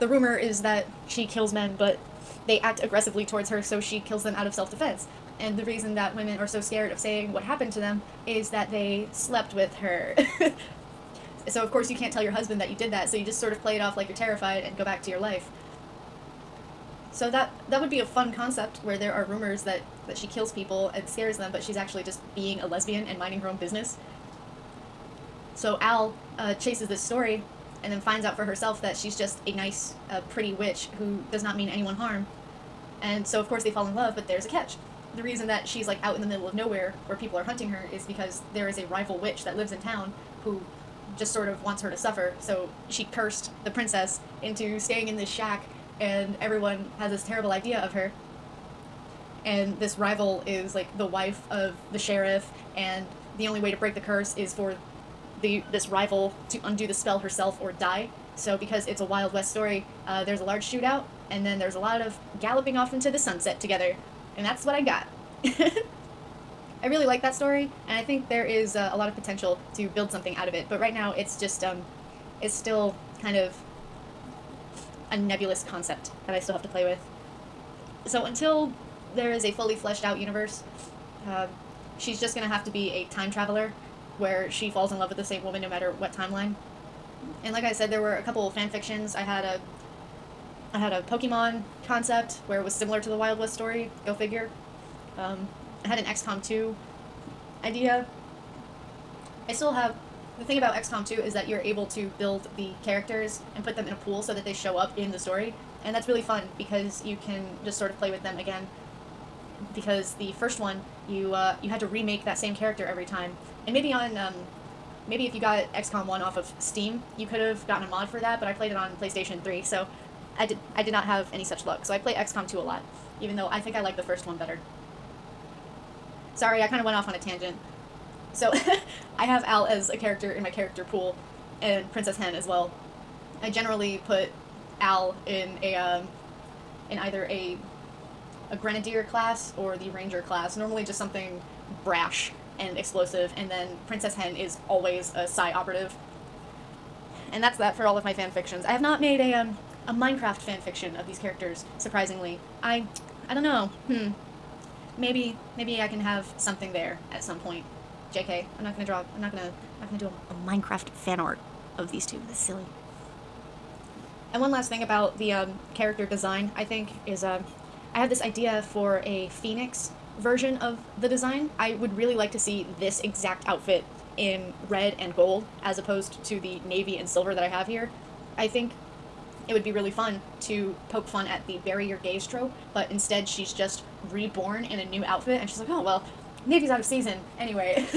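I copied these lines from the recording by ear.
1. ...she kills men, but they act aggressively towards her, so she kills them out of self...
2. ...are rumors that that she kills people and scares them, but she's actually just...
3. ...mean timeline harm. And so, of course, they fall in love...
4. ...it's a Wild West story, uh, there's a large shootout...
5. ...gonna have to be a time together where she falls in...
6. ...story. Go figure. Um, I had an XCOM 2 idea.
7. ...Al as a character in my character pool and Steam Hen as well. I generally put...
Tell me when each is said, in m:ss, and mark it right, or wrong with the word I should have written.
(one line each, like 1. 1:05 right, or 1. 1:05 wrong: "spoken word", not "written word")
1. 0:01 right
2. 0:19 right
3. 0:31 wrong: "anyone", not "timeline"
4. 0:58 right
5. 1:22 wrong: "traveler", not "together"
6. 1:33 right
7. 2:09 wrong: "Princess", not "Steam".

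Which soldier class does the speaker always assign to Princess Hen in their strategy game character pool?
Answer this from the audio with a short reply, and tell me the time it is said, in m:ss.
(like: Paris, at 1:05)
Psi operative, at 2:25.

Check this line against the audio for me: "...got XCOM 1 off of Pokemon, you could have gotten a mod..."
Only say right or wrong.
wrong.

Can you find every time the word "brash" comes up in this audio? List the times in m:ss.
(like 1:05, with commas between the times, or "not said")
2:21.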